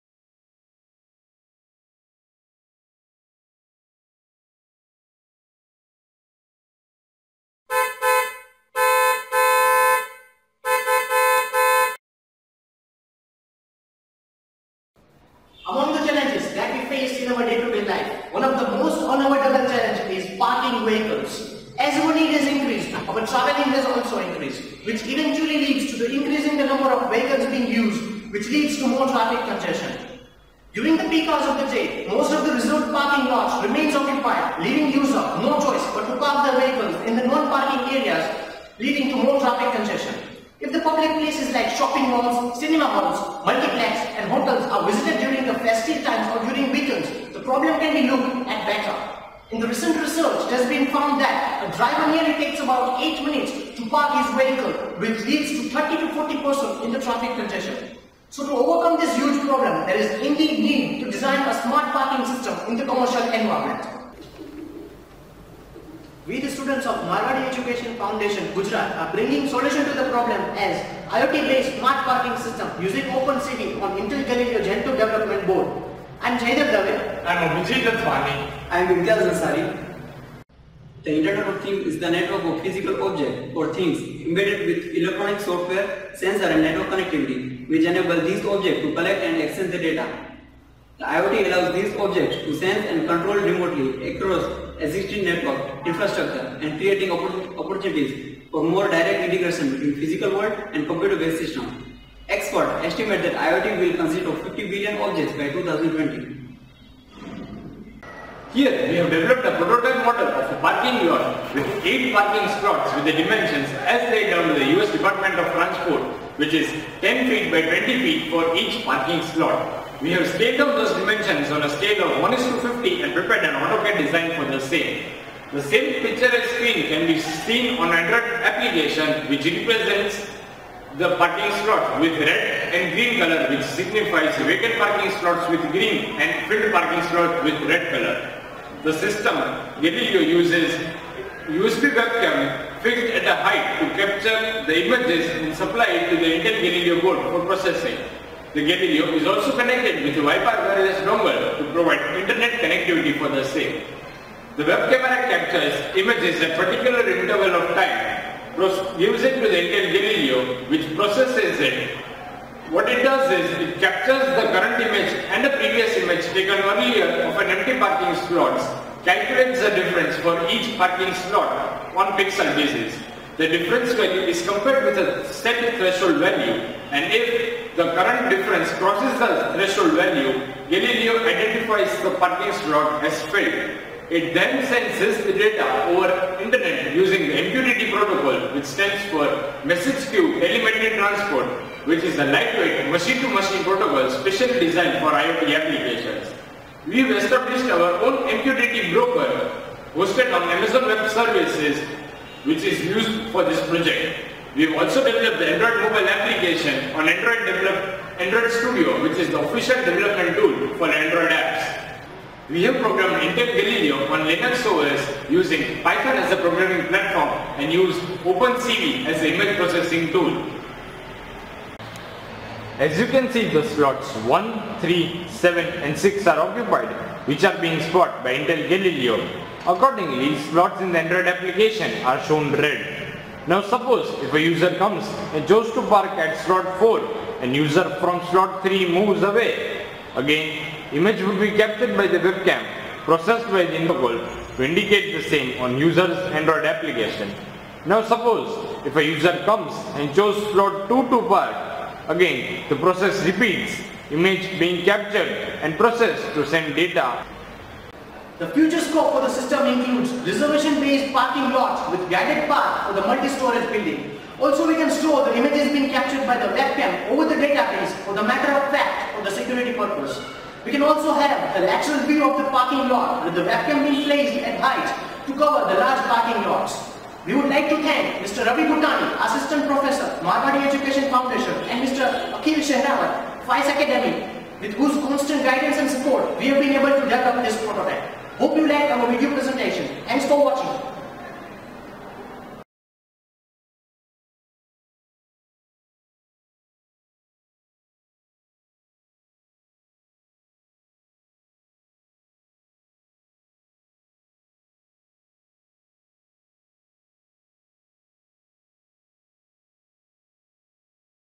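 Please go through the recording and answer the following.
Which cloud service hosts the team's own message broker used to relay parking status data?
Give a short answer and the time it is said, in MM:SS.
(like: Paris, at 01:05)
Amazon Web Services, at 03:20.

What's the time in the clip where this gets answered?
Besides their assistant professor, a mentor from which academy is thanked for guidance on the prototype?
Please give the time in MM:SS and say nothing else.
04:43.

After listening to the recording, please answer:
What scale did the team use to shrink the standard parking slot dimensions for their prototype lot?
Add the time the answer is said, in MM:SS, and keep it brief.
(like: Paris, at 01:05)
1:50, at 02:02.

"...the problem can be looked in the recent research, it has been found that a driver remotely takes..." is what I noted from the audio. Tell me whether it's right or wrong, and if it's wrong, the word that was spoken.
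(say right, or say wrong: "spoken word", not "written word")
wrong: "nearly", not "remotely".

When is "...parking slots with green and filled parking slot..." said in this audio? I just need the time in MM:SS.
02:14.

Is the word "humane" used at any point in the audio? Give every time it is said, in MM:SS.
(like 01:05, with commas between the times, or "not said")
not said.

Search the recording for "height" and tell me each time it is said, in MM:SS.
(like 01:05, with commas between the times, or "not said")
02:23, 04:34.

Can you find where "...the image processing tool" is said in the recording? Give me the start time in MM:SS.
03:39.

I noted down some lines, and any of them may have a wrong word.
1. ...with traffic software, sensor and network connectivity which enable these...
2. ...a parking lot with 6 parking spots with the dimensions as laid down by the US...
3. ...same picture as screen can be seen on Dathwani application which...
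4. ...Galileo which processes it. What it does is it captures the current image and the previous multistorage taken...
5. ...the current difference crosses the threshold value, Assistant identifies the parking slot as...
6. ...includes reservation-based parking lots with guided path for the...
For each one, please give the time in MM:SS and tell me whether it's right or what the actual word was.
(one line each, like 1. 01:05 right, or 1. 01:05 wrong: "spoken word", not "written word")
1. 01:24 wrong: "electronic", not "traffic"
2. 01:50 wrong: "8", not "6"
3. 02:05 wrong: "Android", not "Dathwani"
4. 02:39 wrong: "image", not "multistorage"
5. 02:57 wrong: "Galileo", not "Assistant"
6. 04:19 right.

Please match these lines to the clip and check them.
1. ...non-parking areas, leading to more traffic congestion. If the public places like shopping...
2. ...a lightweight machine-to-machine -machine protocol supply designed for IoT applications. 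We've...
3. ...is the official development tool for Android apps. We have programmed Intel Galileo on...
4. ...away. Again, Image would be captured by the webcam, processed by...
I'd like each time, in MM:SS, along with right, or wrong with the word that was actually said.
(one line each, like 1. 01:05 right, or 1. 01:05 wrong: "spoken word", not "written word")
1. 00:37 right
2. 03:12 wrong: "specially", not "supply"
3. 03:29 right
4. 03:59 right.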